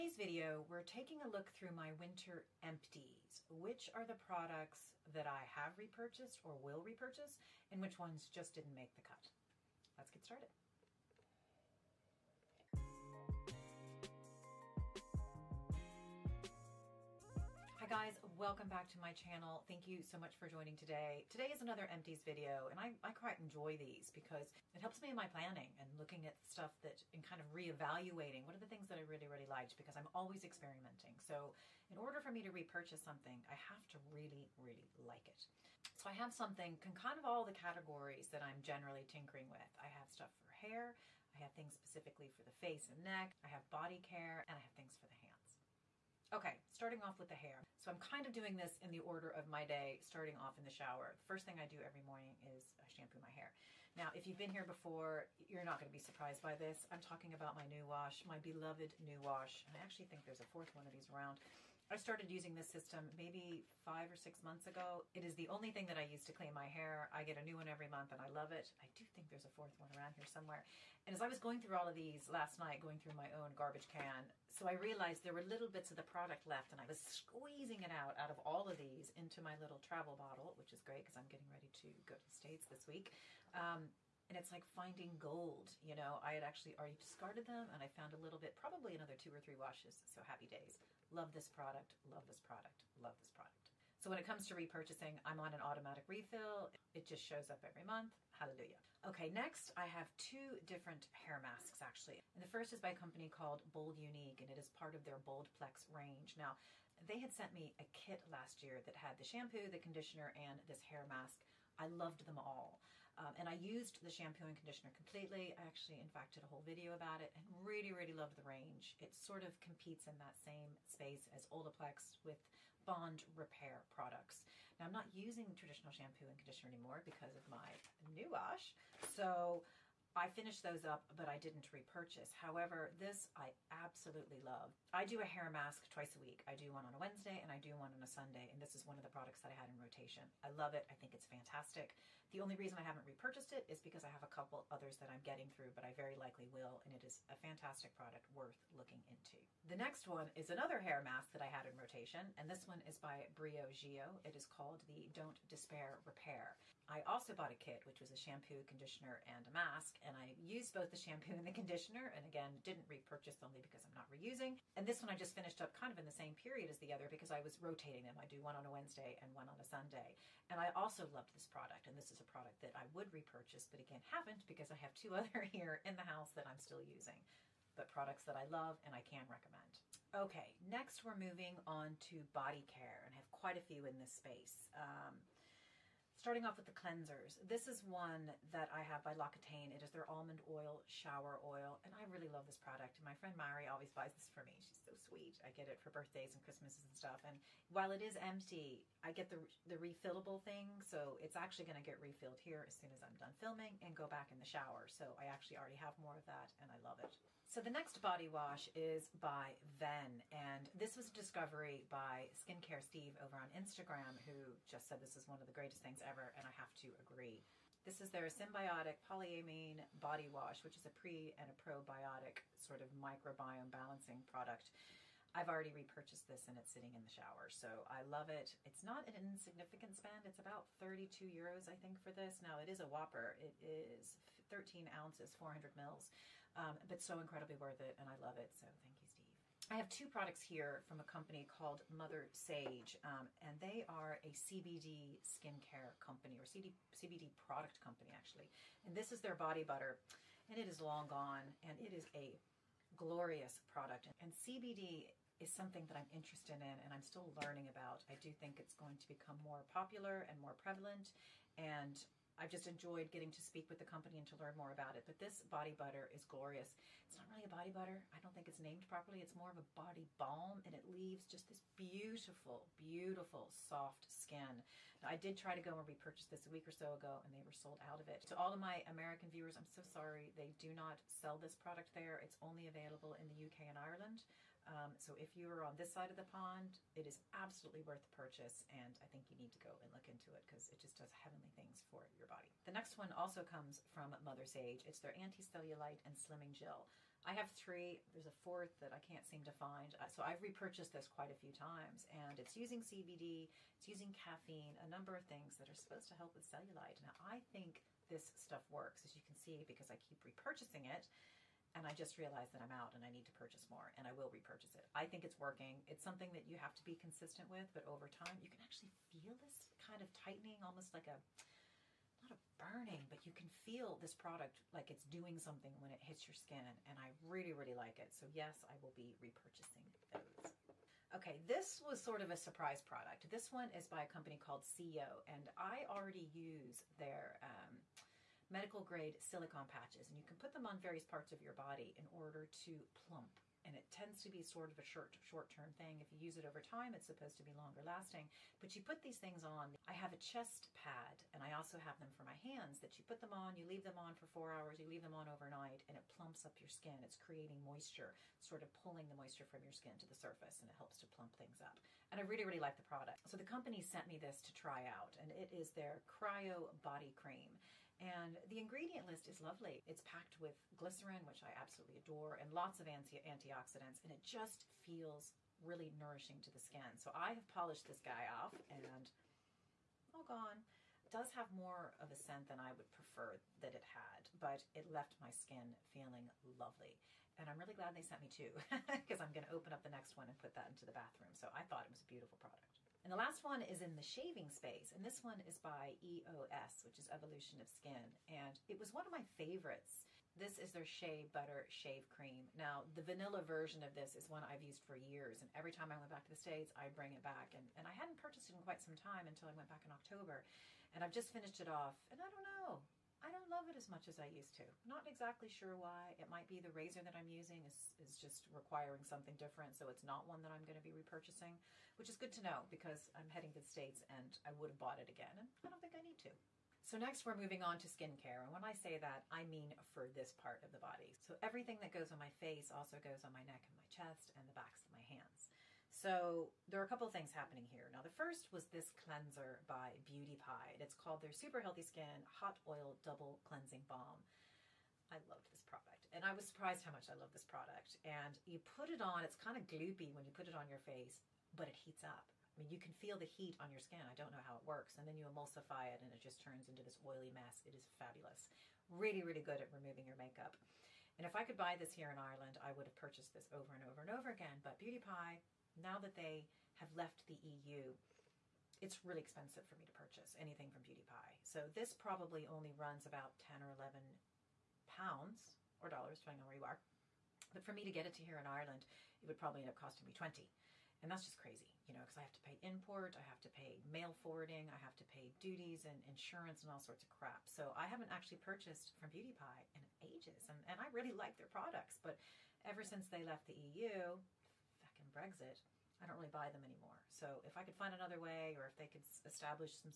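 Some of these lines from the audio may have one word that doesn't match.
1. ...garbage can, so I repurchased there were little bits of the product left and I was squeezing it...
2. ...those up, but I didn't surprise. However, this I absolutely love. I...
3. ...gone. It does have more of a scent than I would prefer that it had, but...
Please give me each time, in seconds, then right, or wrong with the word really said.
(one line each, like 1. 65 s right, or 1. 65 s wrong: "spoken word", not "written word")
1. 73 s wrong: "realized", not "repurchased"
2. 130 s wrong: "repurchase", not "surprise"
3. 380 s right.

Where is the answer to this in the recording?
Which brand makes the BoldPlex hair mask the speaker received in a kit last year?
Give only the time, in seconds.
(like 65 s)
103 s.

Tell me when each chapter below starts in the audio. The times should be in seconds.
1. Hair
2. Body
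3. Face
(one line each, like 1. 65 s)
1. 45 s
2. 179 s
3. 426 s.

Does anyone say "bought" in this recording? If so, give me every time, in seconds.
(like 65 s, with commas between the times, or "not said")
157 s, 424 s.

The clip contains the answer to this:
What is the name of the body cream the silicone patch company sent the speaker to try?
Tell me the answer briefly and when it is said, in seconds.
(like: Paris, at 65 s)
Cryo Body Cream, at 366 s.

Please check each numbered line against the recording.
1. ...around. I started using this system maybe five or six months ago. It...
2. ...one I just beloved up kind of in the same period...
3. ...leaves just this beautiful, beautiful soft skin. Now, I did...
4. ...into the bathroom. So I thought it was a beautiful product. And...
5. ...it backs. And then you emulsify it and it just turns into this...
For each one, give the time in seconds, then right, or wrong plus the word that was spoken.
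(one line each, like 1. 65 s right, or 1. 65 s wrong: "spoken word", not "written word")
1. 61 s right
2. 165 s wrong: "finished", not "beloved"
3. 270 s right
4. 390 s right
5. 454 s wrong: "works", not "backs".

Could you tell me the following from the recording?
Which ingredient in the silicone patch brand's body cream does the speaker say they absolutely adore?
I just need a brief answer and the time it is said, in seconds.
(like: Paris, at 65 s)
glycerin, at 370 s.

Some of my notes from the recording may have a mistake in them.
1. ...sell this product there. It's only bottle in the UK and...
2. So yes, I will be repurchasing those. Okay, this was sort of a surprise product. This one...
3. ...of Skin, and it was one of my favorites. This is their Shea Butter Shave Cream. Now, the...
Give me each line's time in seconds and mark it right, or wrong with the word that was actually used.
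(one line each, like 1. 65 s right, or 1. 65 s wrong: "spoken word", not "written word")
1. 281 s wrong: "available", not "bottle"
2. 328 s right
3. 397 s right.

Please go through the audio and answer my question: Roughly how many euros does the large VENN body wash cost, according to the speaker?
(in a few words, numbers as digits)
32 euros.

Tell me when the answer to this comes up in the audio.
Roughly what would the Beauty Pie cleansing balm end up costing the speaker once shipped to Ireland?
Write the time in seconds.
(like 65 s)
480 s.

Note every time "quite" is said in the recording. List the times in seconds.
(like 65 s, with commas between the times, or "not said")
23 s, 183 s, 301 s, 408 s.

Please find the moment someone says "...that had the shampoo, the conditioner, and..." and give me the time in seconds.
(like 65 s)
108 s.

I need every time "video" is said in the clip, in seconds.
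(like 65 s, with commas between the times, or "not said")
0 s, 22 s, 116 s.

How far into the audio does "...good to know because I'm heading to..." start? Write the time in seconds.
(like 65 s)
422 s.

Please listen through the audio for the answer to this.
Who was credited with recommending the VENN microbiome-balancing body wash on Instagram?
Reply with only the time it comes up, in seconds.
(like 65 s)
212 s.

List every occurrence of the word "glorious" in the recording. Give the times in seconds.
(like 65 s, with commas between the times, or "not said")
252 s, 266 s.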